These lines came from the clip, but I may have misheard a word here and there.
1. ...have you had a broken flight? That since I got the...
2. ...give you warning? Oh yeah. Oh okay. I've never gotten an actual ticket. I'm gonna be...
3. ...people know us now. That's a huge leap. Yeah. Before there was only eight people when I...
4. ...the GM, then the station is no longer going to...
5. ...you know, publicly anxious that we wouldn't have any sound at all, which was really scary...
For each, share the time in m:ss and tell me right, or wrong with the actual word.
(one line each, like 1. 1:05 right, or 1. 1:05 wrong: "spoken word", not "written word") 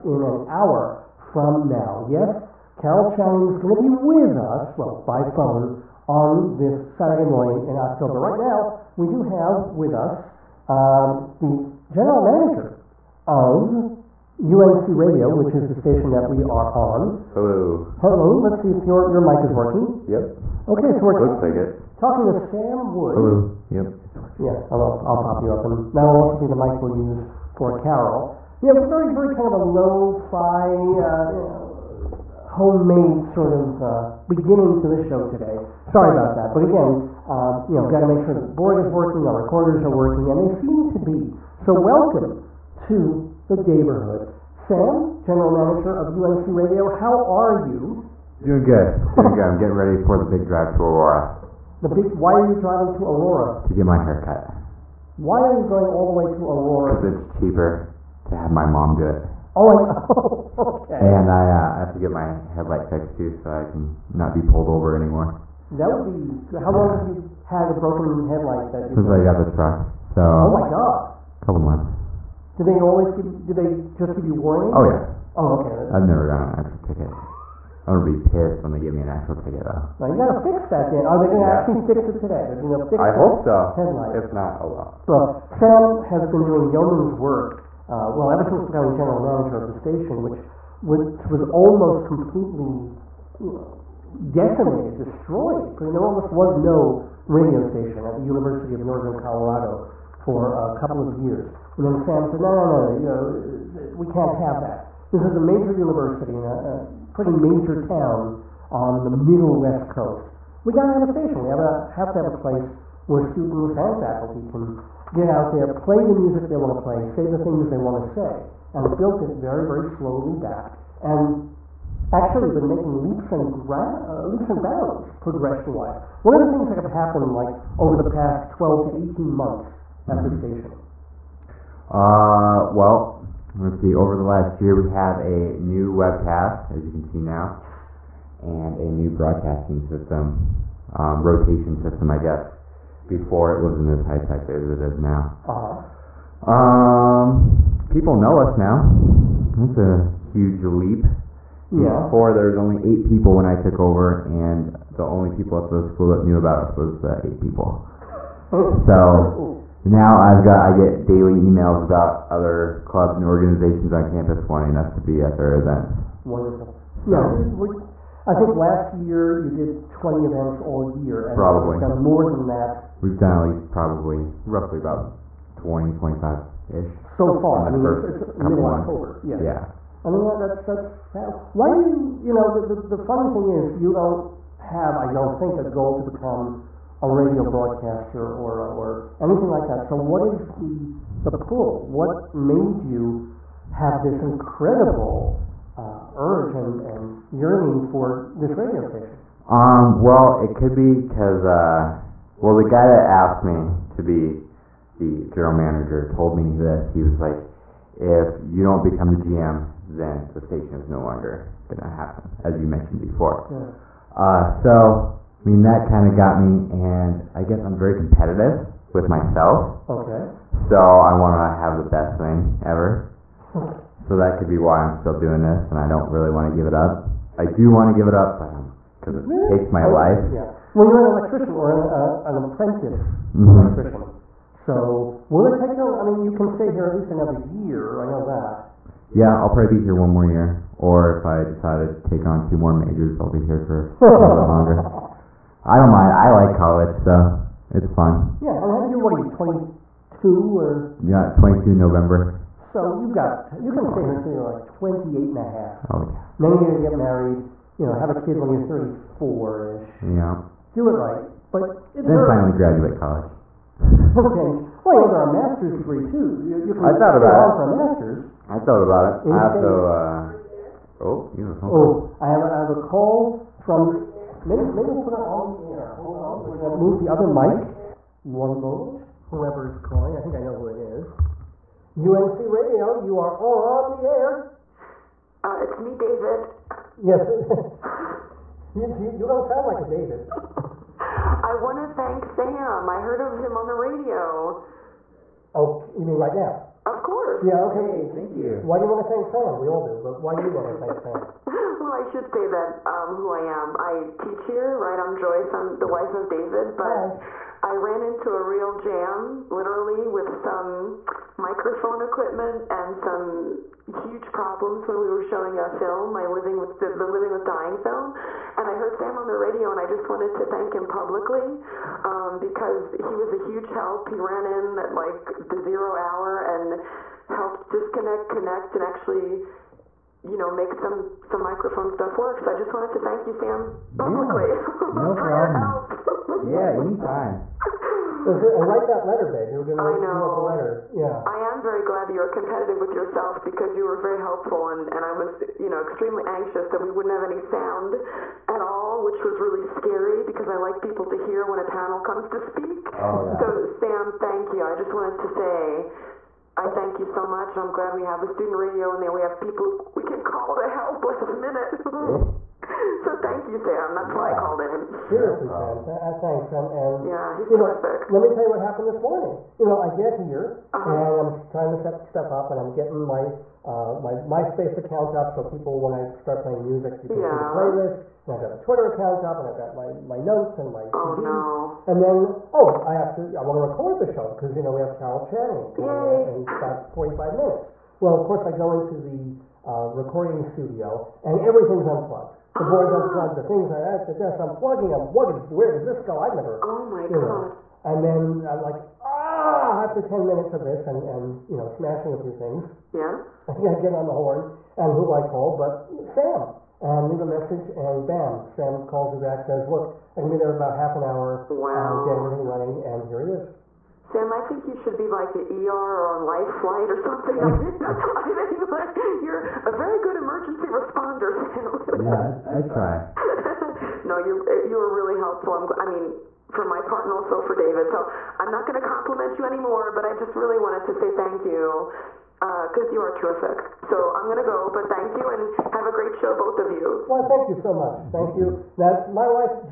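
1. 1:06 wrong: "headlight", not "flight"
2. 1:14 right
3. 2:27 right
4. 3:29 right
5. 5:45 wrong: "extremely", not "publicly".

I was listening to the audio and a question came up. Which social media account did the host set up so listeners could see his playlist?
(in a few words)
MySpace.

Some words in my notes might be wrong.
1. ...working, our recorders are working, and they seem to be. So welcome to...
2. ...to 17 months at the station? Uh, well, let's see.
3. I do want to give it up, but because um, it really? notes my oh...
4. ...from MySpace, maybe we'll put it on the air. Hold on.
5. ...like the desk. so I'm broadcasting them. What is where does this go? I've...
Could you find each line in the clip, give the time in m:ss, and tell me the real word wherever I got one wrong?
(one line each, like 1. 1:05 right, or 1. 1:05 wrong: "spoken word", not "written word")
1. 0:38 right
2. 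2:08 wrong: "18", not "17"
3. 3:47 wrong: "takes", not "notes"
4. 4:33 wrong: "Maybe", not "MySpace"
5. 6:33 wrong: "plugging", not "broadcasting".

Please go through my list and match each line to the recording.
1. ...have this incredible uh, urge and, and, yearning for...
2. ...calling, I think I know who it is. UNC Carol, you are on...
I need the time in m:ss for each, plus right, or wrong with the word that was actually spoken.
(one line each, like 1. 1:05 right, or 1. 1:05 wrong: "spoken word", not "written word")
1. 3:13 right
2. 4:39 wrong: "Radio", not "Carol".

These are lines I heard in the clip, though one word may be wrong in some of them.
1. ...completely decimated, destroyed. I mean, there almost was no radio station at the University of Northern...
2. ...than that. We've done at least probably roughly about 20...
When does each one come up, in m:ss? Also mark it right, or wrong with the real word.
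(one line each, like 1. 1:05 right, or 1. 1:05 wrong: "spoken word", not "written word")
1. 1:32 right
2. 2:52 right.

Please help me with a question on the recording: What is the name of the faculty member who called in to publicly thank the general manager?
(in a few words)
Joyce.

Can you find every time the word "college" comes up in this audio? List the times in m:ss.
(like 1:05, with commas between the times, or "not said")
4:06, 4:22.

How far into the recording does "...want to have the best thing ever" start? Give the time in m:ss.
3:41.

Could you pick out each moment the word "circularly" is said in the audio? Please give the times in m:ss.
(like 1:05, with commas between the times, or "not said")
not said.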